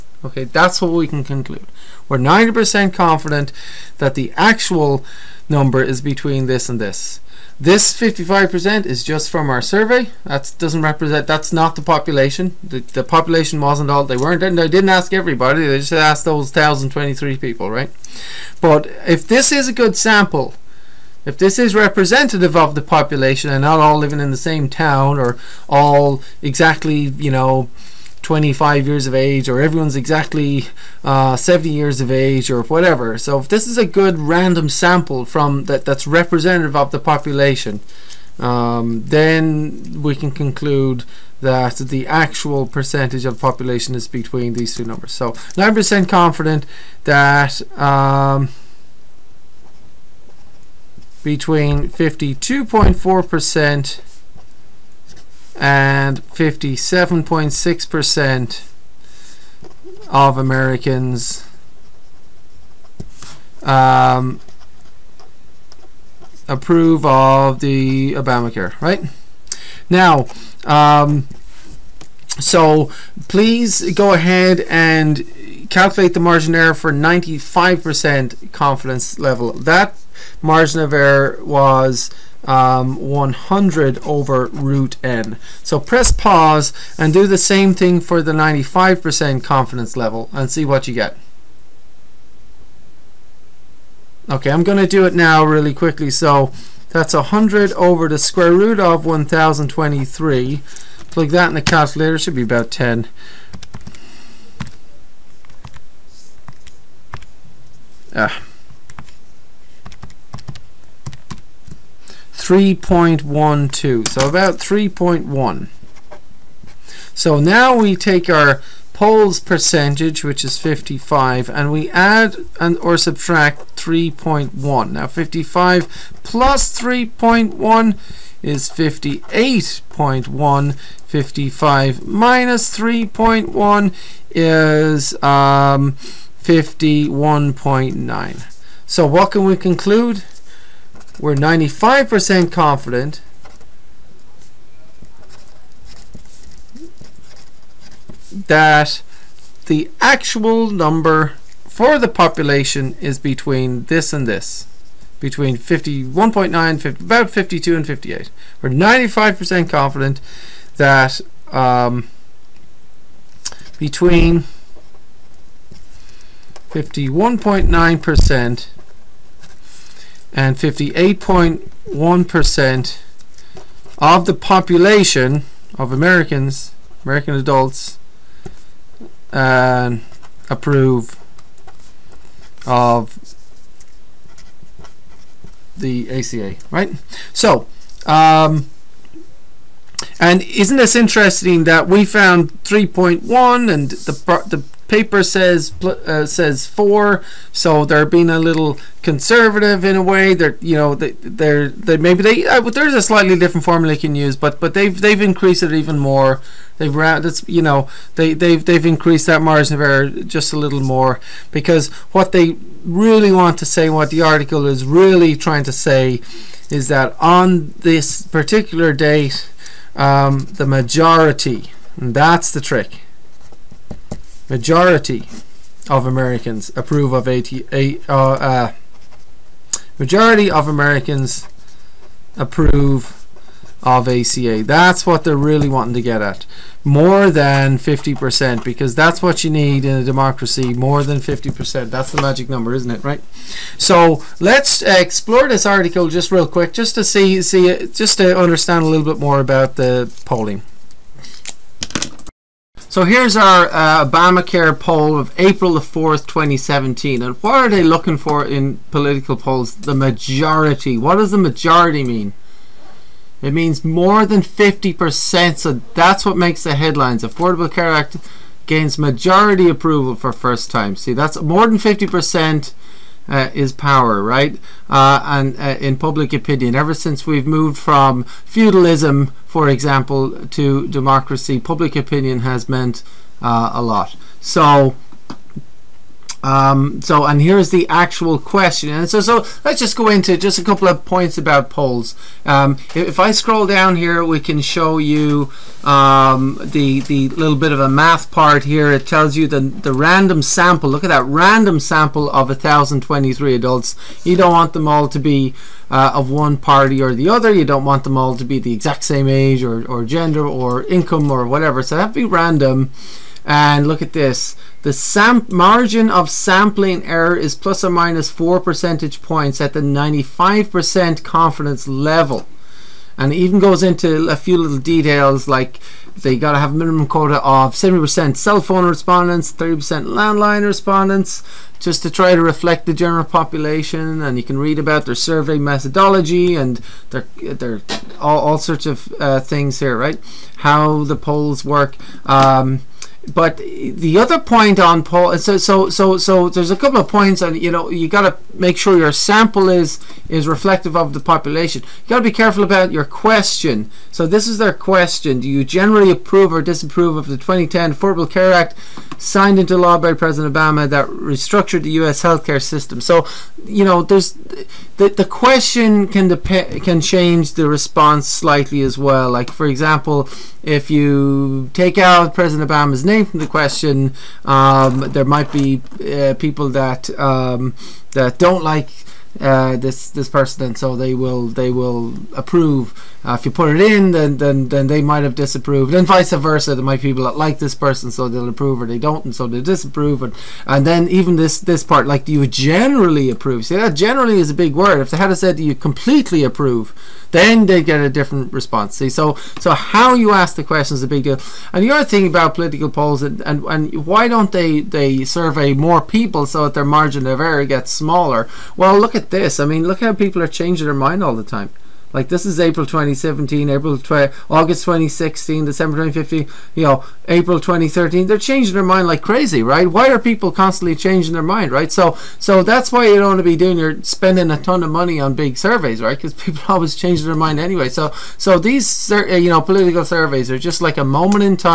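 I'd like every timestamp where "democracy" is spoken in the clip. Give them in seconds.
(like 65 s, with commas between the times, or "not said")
240 s, 280 s.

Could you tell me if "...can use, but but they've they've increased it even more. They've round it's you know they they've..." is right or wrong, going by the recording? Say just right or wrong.
right.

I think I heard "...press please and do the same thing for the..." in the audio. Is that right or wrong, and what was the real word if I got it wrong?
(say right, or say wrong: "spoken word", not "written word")
wrong: "pause", not "please".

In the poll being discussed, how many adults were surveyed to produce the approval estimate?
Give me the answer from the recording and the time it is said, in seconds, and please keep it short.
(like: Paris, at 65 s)
1,023, at 16 s.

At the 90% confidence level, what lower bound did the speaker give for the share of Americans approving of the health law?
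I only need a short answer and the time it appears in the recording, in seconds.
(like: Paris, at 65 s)
52.4%, at 51 s.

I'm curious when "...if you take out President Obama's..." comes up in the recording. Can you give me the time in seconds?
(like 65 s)
370 s.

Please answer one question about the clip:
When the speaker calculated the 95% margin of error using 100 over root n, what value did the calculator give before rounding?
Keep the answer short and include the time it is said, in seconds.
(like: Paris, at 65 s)
3.12, at 112 s.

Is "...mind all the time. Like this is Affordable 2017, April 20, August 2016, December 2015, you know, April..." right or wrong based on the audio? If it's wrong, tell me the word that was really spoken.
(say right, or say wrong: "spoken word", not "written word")
wrong: "April", not "Affordable".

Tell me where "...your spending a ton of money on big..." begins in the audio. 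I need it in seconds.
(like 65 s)
423 s.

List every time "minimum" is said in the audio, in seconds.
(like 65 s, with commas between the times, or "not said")
326 s.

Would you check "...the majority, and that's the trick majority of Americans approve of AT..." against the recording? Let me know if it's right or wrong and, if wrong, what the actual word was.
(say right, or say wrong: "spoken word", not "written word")
right.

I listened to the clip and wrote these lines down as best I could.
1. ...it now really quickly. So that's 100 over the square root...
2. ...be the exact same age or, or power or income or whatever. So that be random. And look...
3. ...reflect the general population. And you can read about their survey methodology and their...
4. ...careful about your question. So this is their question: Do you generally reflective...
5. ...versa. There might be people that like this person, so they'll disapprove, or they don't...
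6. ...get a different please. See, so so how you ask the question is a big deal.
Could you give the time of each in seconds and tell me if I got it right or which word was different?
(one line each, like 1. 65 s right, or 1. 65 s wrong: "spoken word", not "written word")
1. 95 s right
2. 308 s wrong: "gender", not "power"
3. 332 s right
4. 352 s wrong: "approve", not "reflective"
5. 386 s wrong: "approve", not "disapprove"
6. 397 s wrong: "response", not "please".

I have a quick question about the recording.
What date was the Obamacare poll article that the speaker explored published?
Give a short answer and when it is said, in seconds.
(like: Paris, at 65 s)
April 4, 2017, at 255 s.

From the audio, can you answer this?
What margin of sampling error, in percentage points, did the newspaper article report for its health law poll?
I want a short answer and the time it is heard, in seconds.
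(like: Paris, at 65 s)
4, at 317 s.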